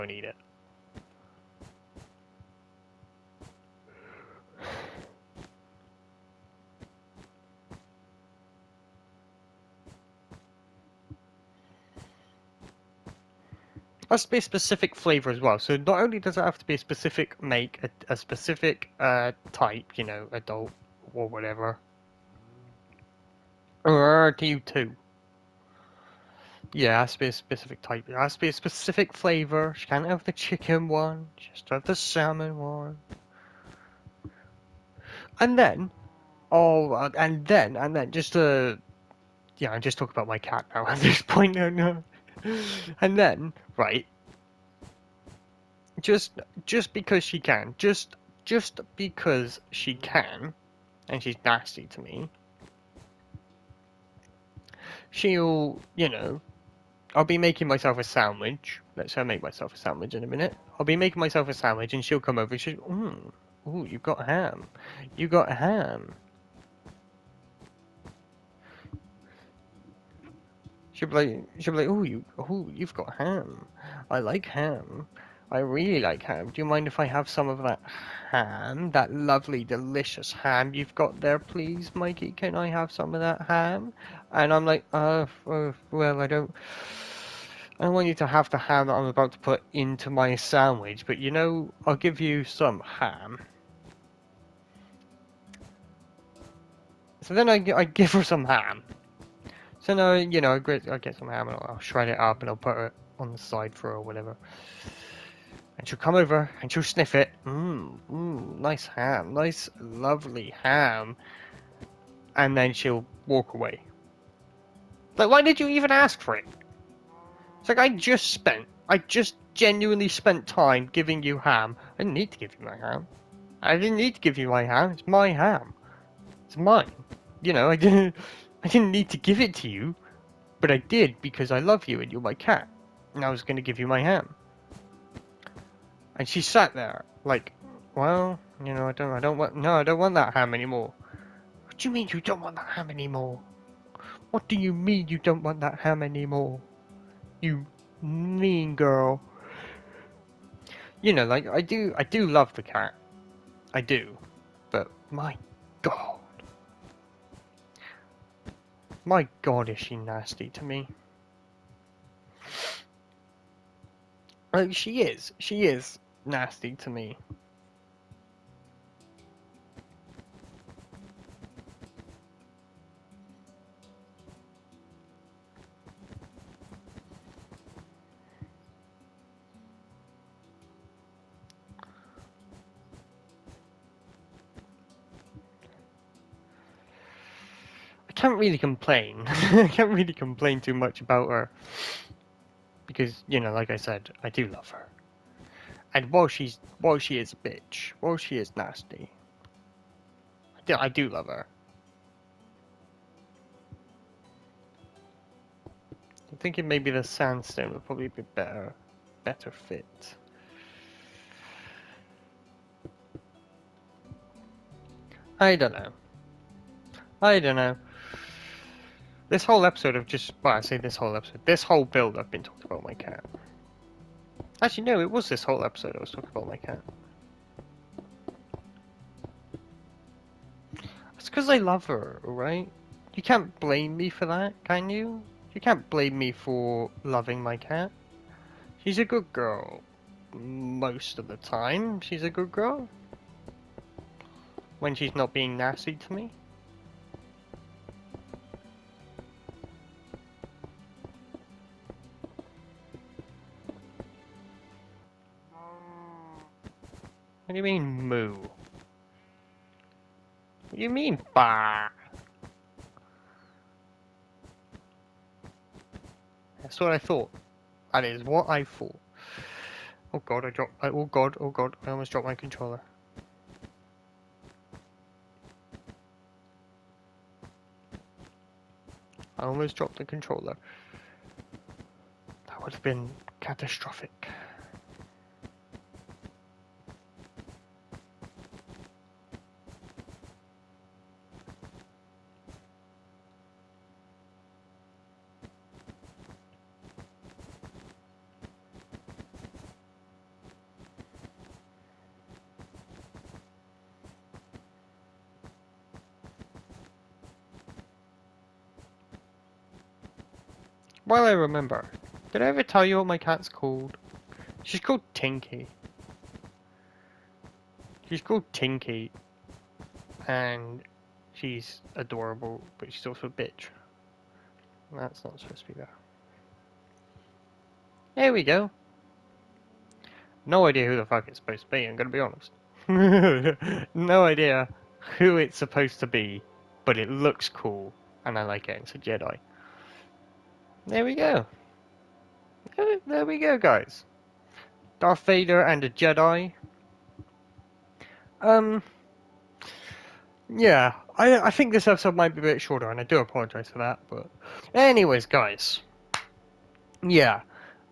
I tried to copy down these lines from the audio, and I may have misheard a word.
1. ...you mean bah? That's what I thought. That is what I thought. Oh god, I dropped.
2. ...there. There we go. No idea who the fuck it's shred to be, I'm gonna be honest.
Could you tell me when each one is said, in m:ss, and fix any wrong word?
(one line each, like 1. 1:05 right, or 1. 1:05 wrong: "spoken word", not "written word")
1. 4:20 right
2. 5:25 wrong: "supposed", not "shred".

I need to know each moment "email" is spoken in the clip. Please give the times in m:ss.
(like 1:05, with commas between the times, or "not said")
not said.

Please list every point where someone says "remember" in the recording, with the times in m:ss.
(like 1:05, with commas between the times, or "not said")
5:11.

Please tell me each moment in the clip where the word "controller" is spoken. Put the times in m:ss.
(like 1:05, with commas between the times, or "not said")
4:32, 4:40.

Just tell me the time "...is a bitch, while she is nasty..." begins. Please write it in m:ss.
3:17.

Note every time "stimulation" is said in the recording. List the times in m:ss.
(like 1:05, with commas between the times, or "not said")
not said.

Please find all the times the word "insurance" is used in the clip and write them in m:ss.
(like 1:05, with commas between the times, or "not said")
not said.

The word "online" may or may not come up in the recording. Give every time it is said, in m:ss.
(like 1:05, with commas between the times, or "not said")
not said.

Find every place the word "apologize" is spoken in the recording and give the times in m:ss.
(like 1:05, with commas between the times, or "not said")
5:53.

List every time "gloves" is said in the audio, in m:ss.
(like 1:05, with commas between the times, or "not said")
not said.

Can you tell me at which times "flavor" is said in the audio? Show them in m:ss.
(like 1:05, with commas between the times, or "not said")
0:14, 0:29.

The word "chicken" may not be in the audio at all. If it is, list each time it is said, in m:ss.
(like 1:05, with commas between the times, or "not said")
0:30.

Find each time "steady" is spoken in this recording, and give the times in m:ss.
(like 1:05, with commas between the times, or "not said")
not said.